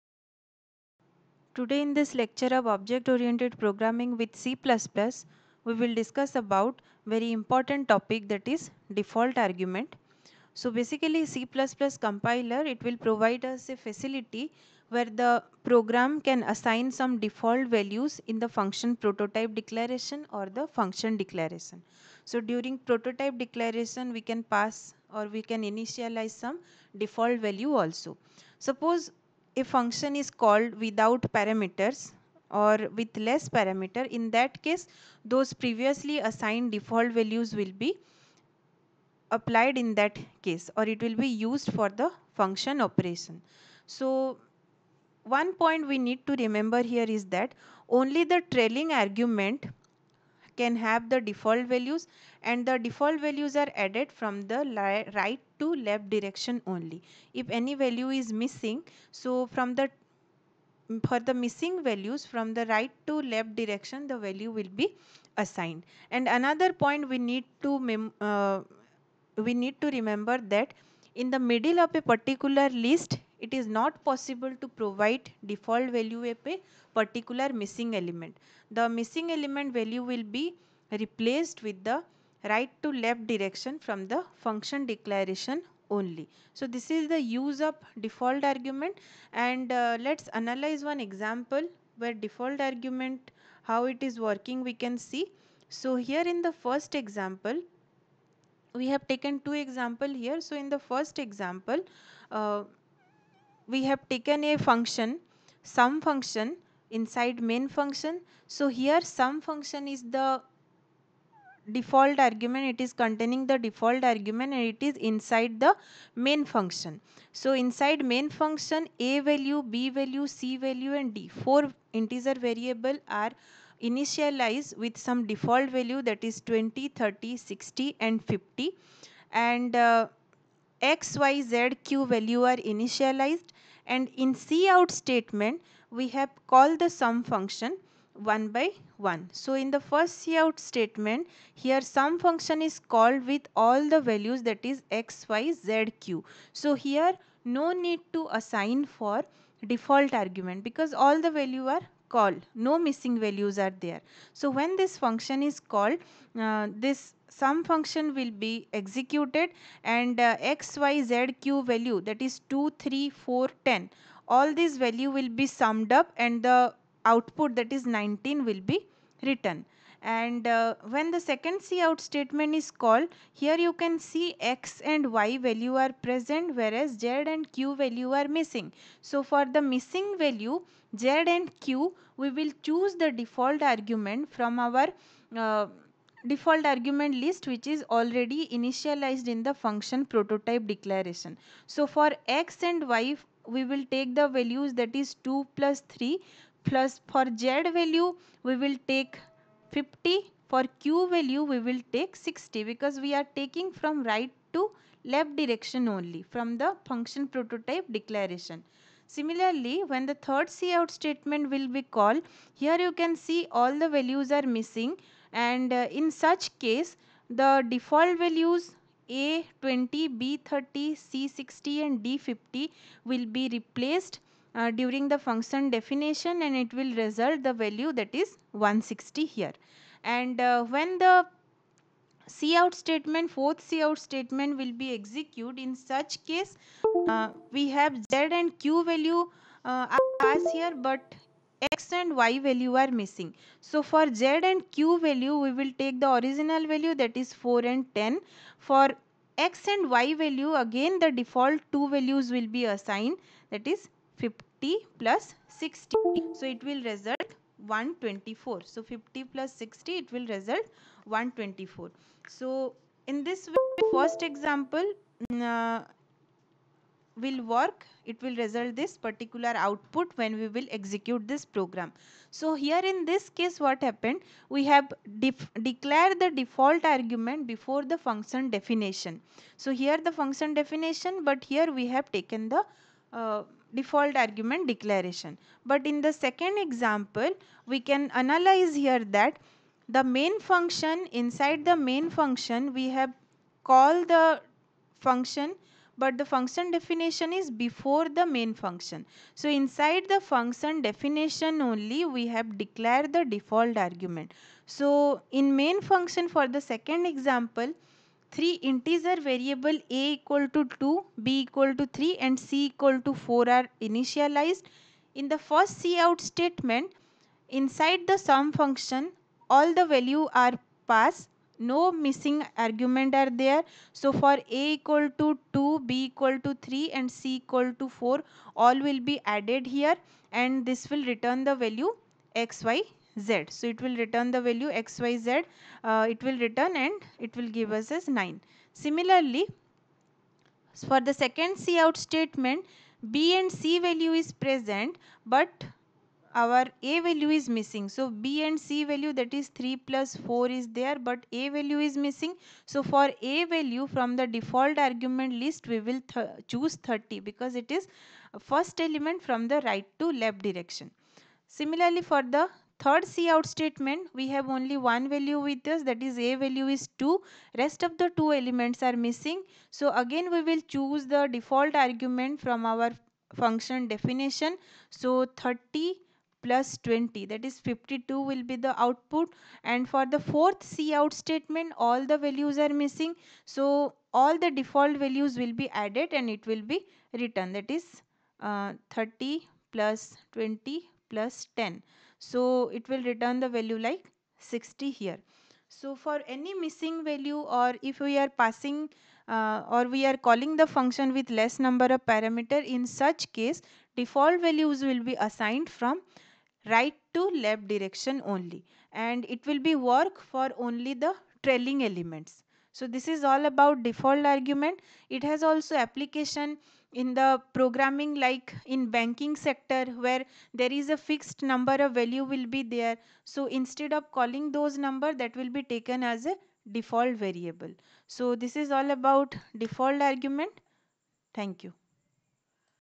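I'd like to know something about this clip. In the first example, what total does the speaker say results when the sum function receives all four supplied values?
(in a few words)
19.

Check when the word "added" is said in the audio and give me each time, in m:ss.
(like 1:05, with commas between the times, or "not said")
0:53, 5:29, 6:25.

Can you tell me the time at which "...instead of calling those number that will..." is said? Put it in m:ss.
7:03.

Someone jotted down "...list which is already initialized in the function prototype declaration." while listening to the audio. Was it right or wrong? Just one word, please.
right.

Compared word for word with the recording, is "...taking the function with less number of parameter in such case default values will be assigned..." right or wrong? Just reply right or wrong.
wrong.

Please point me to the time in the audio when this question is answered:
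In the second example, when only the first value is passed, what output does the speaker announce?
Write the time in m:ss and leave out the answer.
6:17.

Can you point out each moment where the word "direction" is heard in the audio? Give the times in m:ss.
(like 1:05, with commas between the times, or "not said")
0:56, 1:03, 1:23, 3:25, 6:00, 6:47.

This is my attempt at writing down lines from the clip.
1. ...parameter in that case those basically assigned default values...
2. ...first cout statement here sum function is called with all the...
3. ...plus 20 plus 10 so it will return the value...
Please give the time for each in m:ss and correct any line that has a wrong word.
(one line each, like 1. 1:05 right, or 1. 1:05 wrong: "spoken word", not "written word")
1. 0:33 wrong: "previously", not "basically"
2. 2:19 right
3. 6:29 right.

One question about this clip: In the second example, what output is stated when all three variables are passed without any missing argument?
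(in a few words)
9.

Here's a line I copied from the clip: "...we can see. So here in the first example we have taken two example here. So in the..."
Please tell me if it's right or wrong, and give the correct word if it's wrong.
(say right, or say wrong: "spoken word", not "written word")
right.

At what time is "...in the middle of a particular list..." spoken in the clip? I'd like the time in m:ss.
1:11.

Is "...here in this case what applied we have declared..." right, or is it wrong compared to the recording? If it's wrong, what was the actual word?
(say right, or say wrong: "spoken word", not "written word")
wrong: "happened", not "applied".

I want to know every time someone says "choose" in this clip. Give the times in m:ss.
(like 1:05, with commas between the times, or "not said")
3:02, 5:56, 6:10.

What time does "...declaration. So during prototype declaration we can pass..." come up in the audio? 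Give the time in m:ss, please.
0:21.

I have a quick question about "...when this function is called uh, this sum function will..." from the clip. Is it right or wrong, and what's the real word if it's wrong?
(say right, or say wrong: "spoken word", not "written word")
right.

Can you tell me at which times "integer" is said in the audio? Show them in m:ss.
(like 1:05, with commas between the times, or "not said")
2:02, 5:08.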